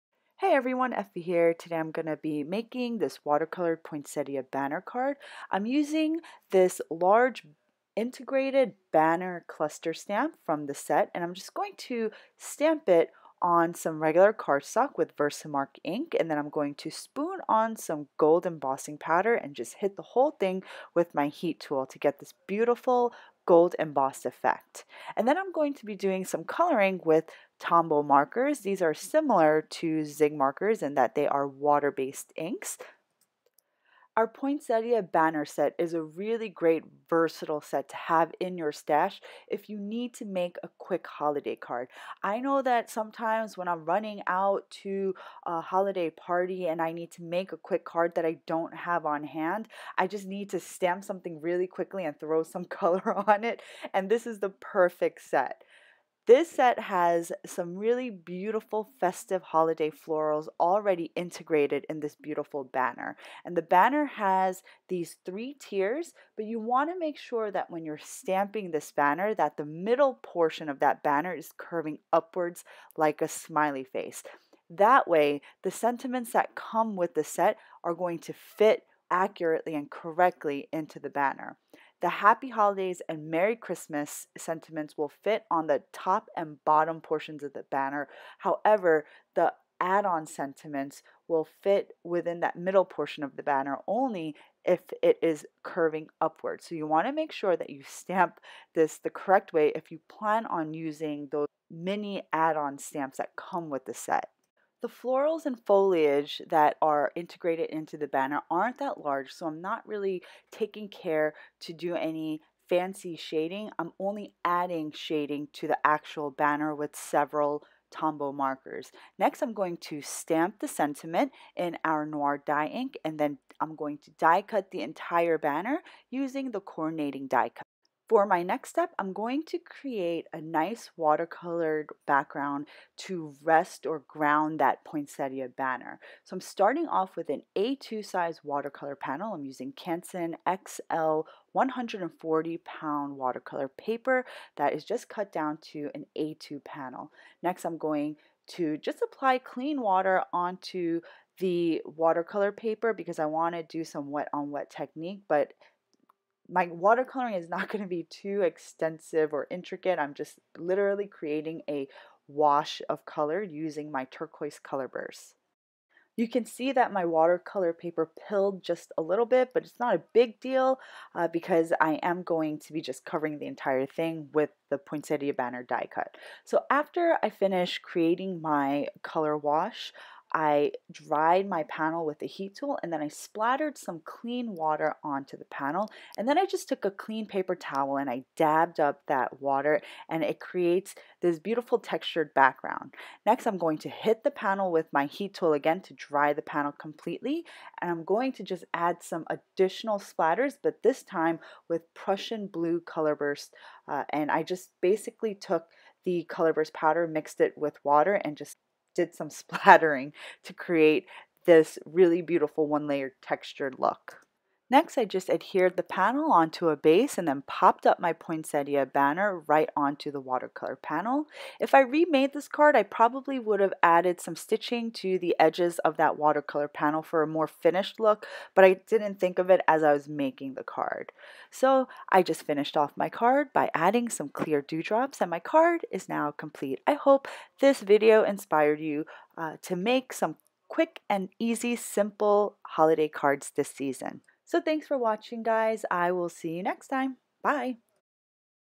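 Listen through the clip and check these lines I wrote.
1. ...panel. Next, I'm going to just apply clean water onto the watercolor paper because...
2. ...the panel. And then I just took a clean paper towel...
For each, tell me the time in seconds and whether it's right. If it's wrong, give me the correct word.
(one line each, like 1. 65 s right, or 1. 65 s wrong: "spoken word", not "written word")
1. 146 s right
2. 185 s right.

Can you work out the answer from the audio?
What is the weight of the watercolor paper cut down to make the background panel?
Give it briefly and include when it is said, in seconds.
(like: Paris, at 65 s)
140 pound, at 141 s.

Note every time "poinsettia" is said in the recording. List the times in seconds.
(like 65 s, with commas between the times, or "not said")
3 s, 34 s, 134 s, 174 s, 218 s.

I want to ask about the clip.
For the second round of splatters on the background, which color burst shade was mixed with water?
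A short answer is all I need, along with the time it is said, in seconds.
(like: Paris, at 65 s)
Prussian blue, at 201 s.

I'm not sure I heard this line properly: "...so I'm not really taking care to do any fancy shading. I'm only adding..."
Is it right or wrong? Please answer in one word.
right.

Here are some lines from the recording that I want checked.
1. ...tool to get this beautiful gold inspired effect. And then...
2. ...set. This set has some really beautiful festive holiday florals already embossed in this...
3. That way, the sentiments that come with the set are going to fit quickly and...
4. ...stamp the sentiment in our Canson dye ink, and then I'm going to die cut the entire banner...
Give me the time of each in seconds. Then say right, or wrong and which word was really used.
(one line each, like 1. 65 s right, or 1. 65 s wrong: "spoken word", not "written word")
1. 21 s wrong: "embossed", not "inspired"
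2. 55 s wrong: "integrated", not "embossed"
3. 74 s wrong: "accurately", not "quickly"
4. 120 s wrong: "Noir", not "Canson".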